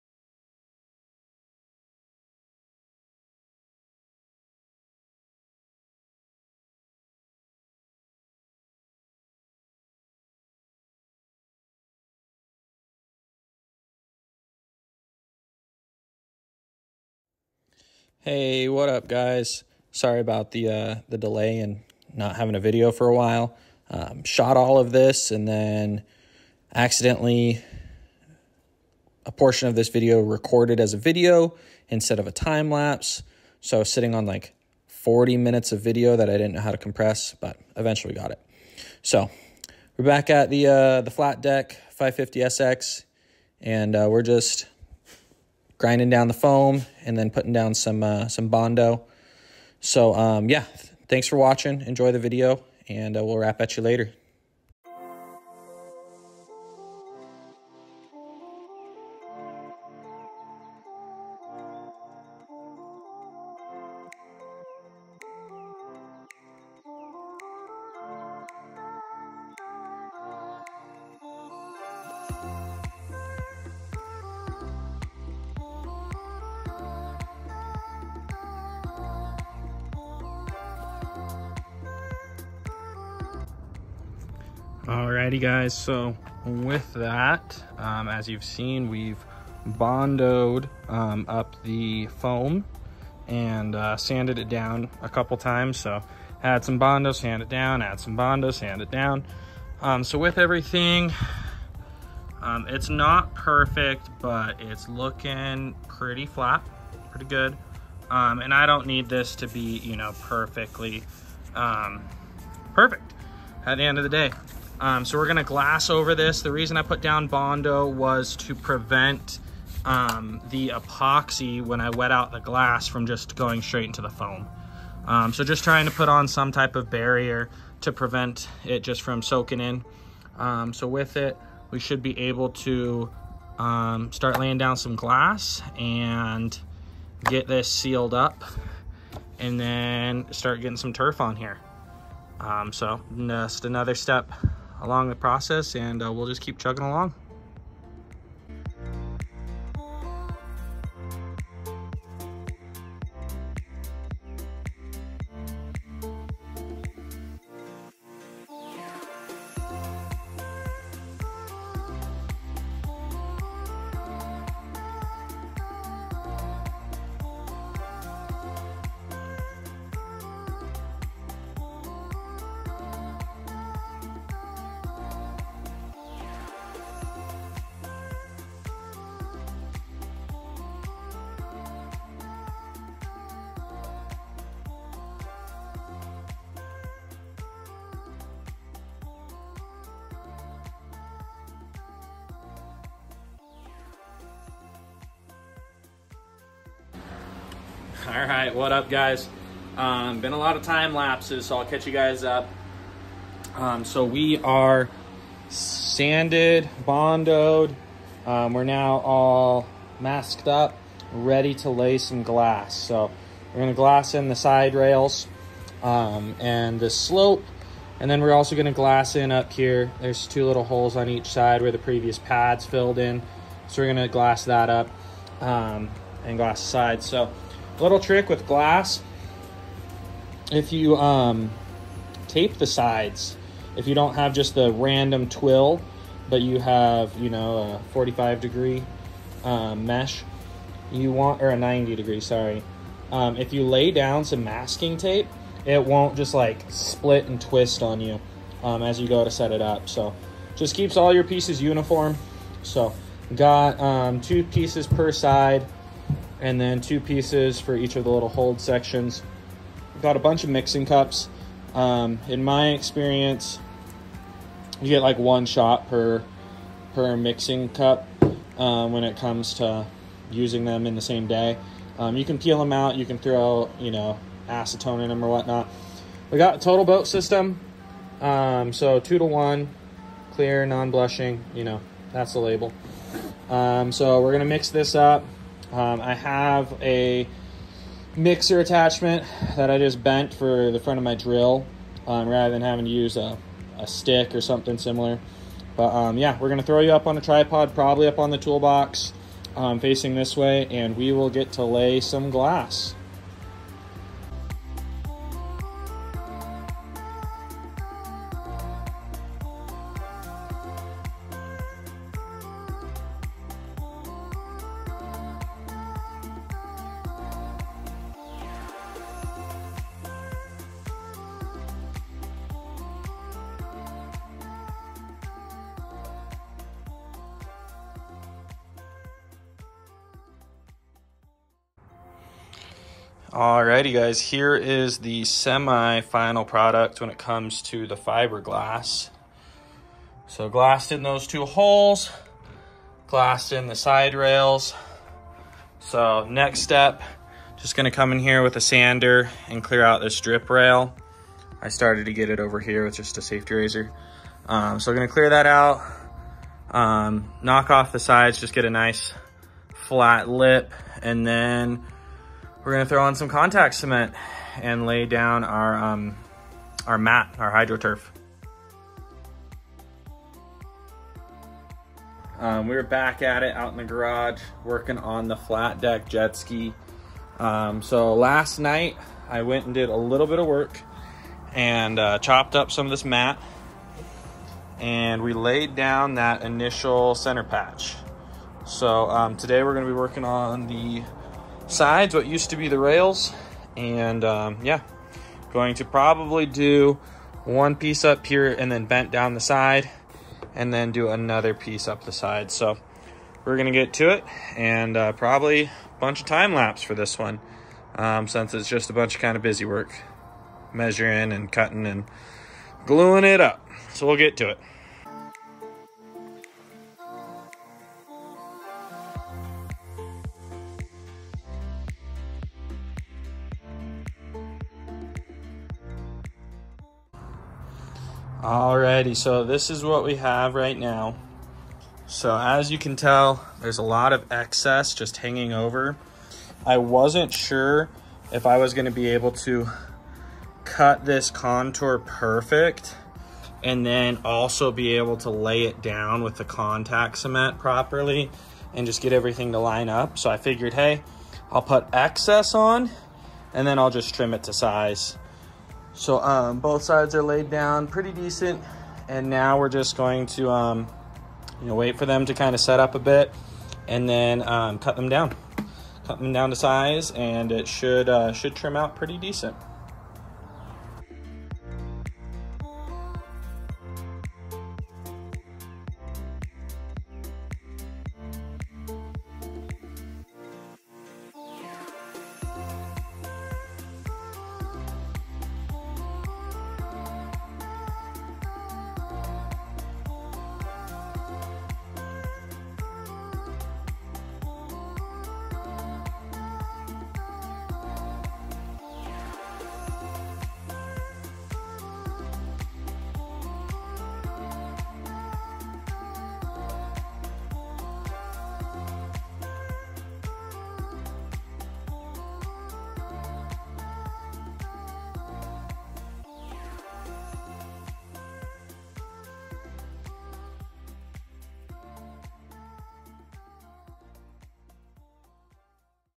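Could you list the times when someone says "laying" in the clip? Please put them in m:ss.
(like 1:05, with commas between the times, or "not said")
2:14.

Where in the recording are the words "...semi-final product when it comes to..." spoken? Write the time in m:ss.
5:35.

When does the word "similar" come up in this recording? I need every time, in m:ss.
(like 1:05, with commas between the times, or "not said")
4:54.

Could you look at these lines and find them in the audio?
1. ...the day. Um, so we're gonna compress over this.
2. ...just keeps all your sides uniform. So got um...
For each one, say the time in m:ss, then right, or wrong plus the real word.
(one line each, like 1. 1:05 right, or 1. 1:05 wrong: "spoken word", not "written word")
1. 1:54 wrong: "glass", not "compress"
2. 4:10 wrong: "pieces", not "sides".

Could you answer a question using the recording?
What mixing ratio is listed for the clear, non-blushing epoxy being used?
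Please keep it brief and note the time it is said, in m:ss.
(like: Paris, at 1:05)
2 to 1, at 4:38.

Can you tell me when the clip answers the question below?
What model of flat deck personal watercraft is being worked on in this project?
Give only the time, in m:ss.
0:41.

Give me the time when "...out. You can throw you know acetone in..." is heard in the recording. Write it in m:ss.
4:32.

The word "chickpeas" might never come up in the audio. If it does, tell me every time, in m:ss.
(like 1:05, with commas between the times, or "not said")
not said.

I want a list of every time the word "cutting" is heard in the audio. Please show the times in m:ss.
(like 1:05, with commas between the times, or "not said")
6:51.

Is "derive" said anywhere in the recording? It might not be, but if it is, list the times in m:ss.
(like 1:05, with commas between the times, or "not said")
not said.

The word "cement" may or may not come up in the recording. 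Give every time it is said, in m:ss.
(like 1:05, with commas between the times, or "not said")
6:03, 7:27.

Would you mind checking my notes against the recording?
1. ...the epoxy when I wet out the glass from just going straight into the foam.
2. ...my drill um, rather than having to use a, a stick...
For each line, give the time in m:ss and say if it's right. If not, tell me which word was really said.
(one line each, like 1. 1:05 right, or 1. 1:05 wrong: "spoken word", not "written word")
1. 2:00 right
2. 4:51 right.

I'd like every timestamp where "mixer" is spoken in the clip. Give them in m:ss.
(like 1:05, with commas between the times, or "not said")
4:48.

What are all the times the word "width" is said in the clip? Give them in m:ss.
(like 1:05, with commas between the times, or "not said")
not said.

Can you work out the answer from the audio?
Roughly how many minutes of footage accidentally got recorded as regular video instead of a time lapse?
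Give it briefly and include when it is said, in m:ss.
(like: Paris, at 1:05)
40 minutes, at 0:34.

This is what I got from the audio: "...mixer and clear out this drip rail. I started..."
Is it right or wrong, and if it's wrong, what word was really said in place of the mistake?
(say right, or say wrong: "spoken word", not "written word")
wrong: "sander", not "mixer".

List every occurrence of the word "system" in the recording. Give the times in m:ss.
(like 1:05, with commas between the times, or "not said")
4:37.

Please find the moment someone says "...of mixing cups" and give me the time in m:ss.
4:20.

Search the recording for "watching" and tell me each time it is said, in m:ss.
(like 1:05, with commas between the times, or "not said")
0:51.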